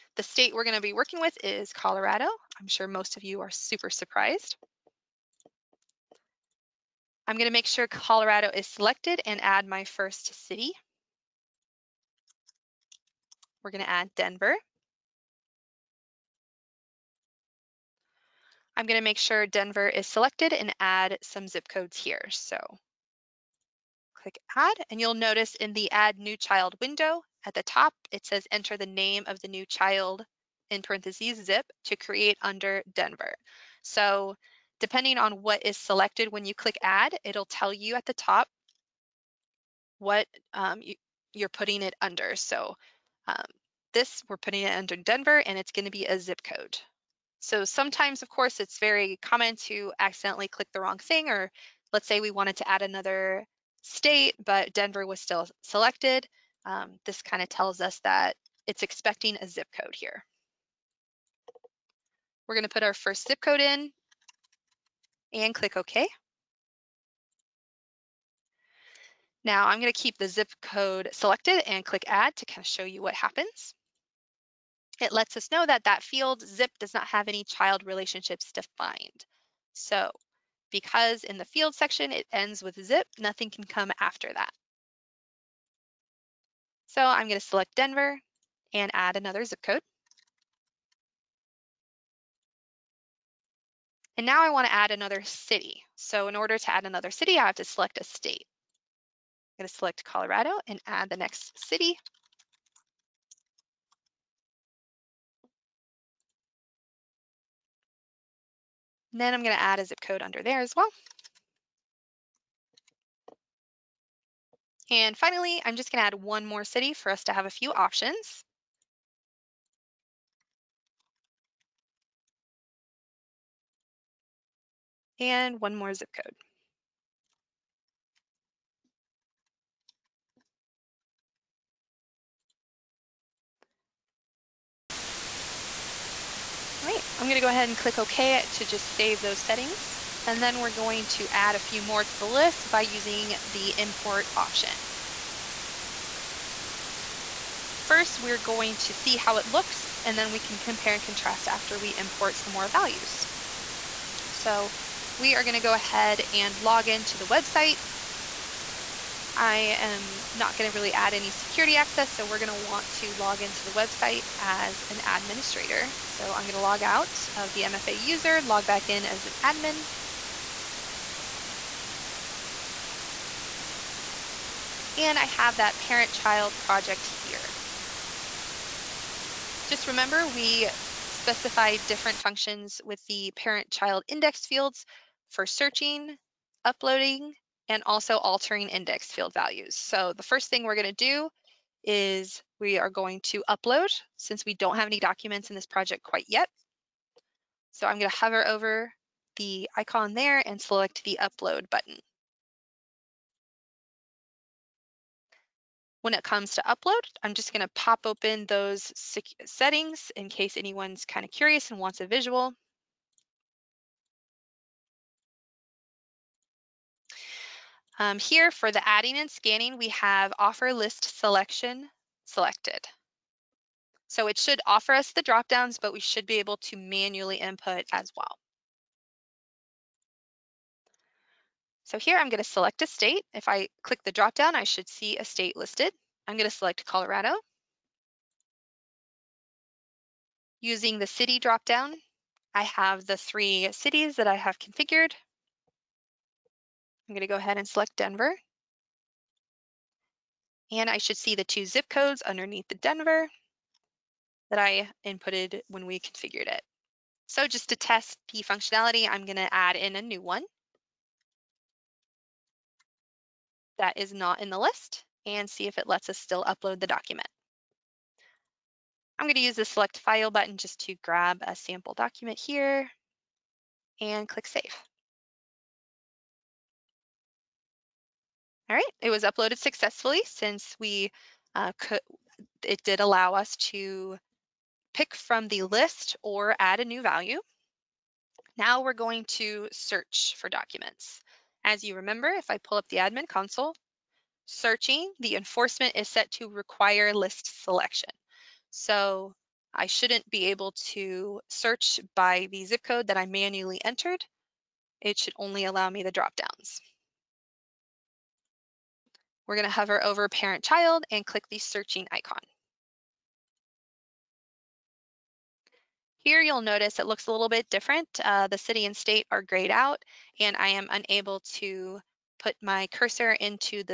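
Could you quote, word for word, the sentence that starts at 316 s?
Here you'll notice it looks a little bit different.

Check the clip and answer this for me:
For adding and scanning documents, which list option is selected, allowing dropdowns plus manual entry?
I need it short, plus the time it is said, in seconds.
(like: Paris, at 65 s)
offer list selection, at 220 s.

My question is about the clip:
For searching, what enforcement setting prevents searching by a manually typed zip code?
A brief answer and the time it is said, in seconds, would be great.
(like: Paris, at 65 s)
require list selection, at 296 s.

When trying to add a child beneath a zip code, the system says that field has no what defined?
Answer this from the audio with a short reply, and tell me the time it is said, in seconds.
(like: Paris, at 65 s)
child relationships, at 77 s.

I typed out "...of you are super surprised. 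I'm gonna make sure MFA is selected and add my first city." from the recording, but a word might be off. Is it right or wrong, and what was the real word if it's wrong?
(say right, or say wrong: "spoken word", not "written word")
wrong: "Colorado", not "MFA".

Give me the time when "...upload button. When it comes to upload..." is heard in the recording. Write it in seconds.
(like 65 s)
201 s.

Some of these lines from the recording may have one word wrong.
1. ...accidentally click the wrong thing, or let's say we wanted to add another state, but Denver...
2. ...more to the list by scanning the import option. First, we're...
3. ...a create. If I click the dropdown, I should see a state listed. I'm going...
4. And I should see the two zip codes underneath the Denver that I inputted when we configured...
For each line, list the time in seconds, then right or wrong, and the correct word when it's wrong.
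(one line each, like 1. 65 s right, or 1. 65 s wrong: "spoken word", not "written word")
1. 49 s right
2. 141 s wrong: "using", not "scanning"
3. 232 s wrong: "state", not "create"
4. 250 s right.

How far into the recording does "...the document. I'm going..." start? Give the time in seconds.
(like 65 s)
266 s.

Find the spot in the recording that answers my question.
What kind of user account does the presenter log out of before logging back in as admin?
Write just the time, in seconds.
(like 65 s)
167 s.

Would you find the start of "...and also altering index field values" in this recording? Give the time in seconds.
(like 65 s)
187 s.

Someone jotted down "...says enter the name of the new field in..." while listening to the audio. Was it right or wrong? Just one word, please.
wrong.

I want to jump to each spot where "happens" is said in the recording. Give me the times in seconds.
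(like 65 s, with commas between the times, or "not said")
73 s.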